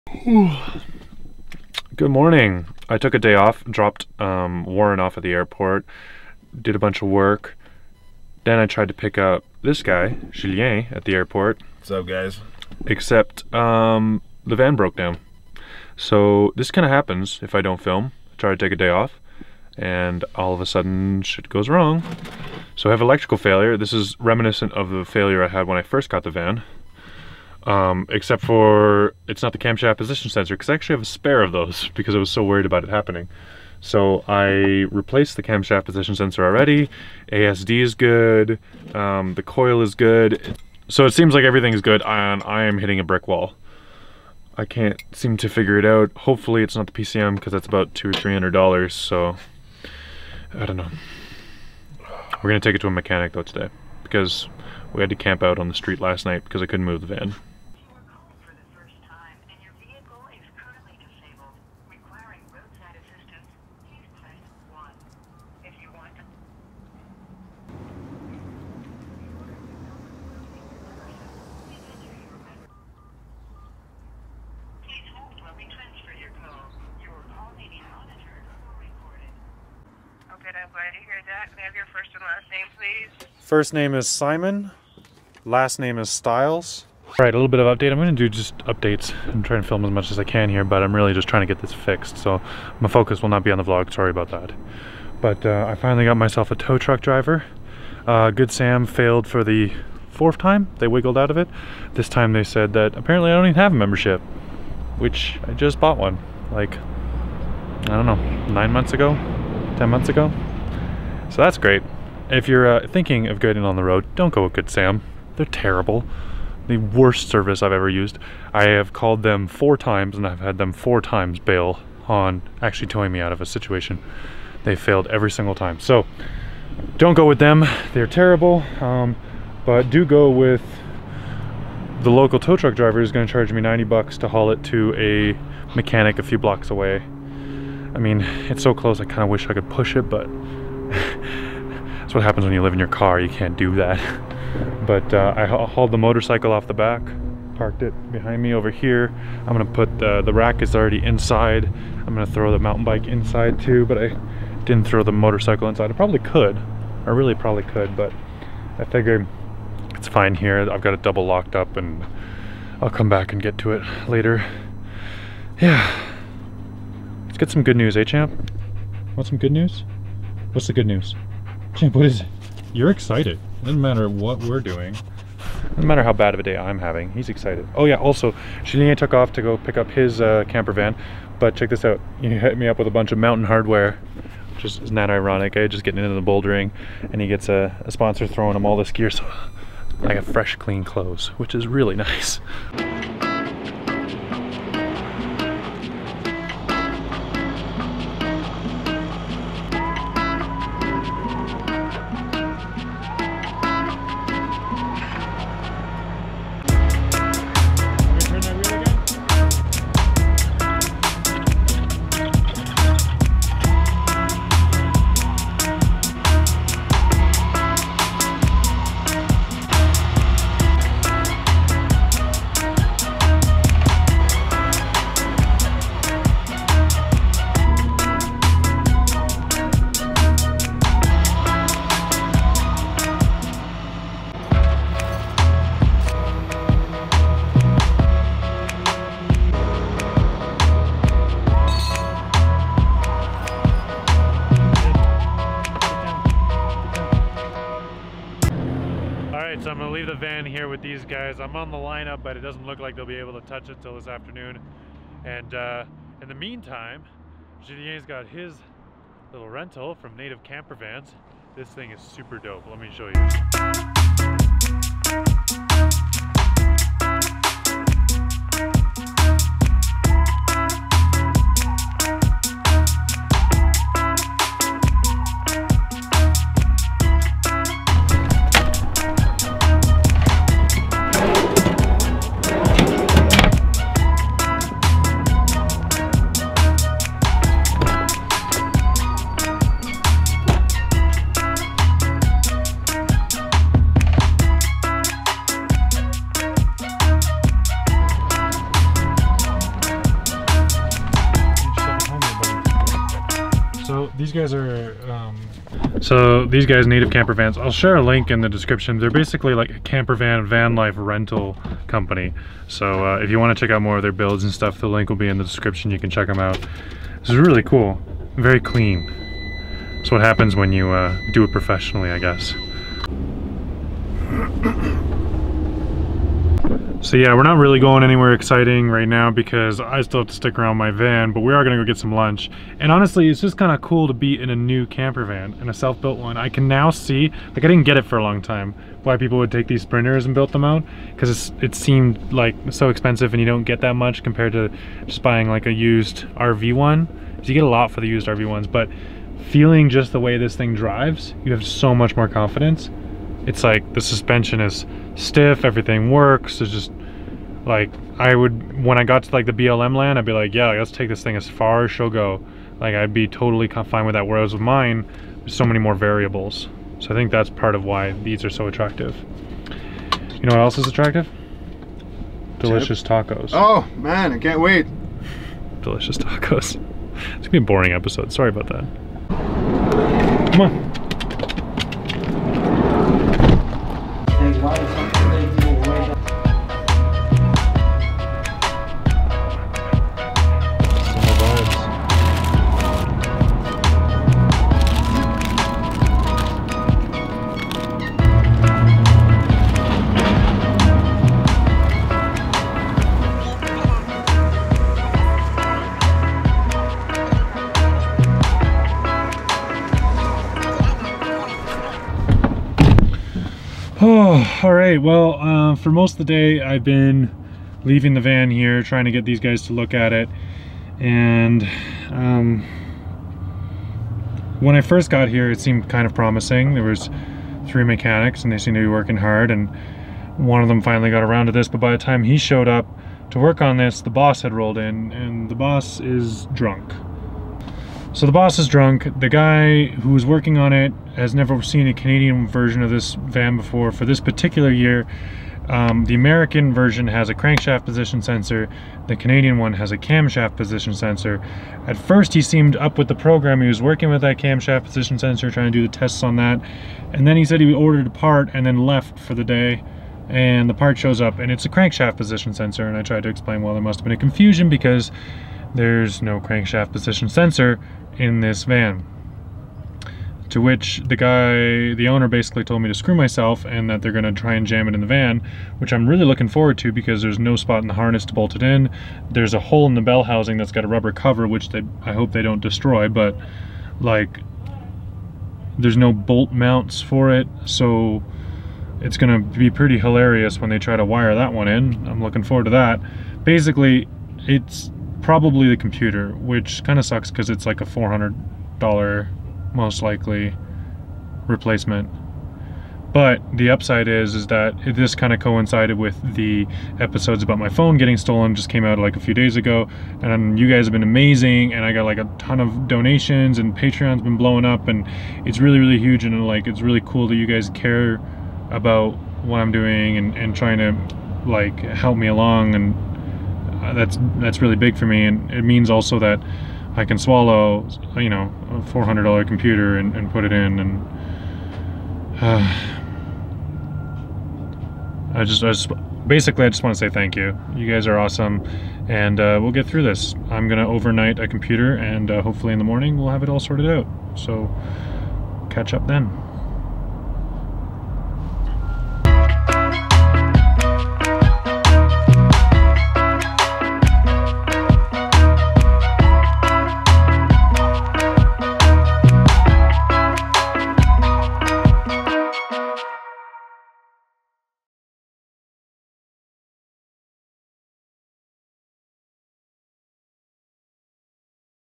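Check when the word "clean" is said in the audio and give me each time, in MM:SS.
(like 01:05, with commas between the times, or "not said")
03:10, 05:18.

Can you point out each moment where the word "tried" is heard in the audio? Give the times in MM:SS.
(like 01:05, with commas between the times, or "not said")
00:08, 07:43.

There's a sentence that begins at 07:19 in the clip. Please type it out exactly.
The guy who was working on it has never seen a Canadian version of this van before.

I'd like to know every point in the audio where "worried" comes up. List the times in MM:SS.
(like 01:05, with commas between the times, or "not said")
00:32.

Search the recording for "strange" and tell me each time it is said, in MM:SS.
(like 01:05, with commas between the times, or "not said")
not said.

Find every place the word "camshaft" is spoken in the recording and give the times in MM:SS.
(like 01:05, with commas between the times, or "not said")
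00:29, 00:35, 07:29, 07:34.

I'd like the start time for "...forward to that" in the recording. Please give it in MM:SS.
08:12.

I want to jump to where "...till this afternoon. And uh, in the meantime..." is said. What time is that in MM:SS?
04:13.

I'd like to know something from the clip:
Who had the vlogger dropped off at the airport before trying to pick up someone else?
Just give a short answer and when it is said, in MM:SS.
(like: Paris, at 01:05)
Warren, at 00:04.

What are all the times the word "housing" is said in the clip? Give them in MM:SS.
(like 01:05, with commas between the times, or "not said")
08:00.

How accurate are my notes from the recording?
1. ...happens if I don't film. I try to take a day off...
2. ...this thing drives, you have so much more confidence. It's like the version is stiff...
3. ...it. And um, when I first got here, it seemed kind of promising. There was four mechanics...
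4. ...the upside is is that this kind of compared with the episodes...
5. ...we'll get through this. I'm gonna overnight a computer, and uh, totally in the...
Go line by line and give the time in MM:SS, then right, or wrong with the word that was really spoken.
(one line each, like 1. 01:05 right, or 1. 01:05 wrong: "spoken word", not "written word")
1. 00:16 right
2. 05:50 wrong: "suspension", not "version"
3. 07:00 wrong: "three", not "four"
4. 08:23 wrong: "coincided", not "compared"
5. 08:59 wrong: "hopefully", not "totally".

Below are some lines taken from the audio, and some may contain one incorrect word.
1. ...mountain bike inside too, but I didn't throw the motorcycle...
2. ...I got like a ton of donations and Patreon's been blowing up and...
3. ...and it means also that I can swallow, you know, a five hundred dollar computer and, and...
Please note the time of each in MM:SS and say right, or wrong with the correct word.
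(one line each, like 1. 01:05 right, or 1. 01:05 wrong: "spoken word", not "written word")
1. 02:32 right
2. 08:31 right
3. 08:45 wrong: "four", not "five".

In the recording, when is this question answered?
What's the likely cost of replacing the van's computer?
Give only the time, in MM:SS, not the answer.
08:17.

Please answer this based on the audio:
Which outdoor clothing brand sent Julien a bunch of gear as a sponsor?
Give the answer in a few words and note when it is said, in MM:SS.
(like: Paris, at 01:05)
Mountain Hardwear, at 03:03.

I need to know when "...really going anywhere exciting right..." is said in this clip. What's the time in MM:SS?
05:27.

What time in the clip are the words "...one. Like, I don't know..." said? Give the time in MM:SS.
01:45.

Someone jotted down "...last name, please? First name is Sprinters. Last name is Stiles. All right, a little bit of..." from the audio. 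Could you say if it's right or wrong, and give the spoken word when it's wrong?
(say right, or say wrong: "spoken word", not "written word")
wrong: "Simon", not "Sprinters".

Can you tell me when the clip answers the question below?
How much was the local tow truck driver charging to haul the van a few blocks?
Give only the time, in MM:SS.
02:13.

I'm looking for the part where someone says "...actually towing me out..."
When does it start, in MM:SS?
02:02.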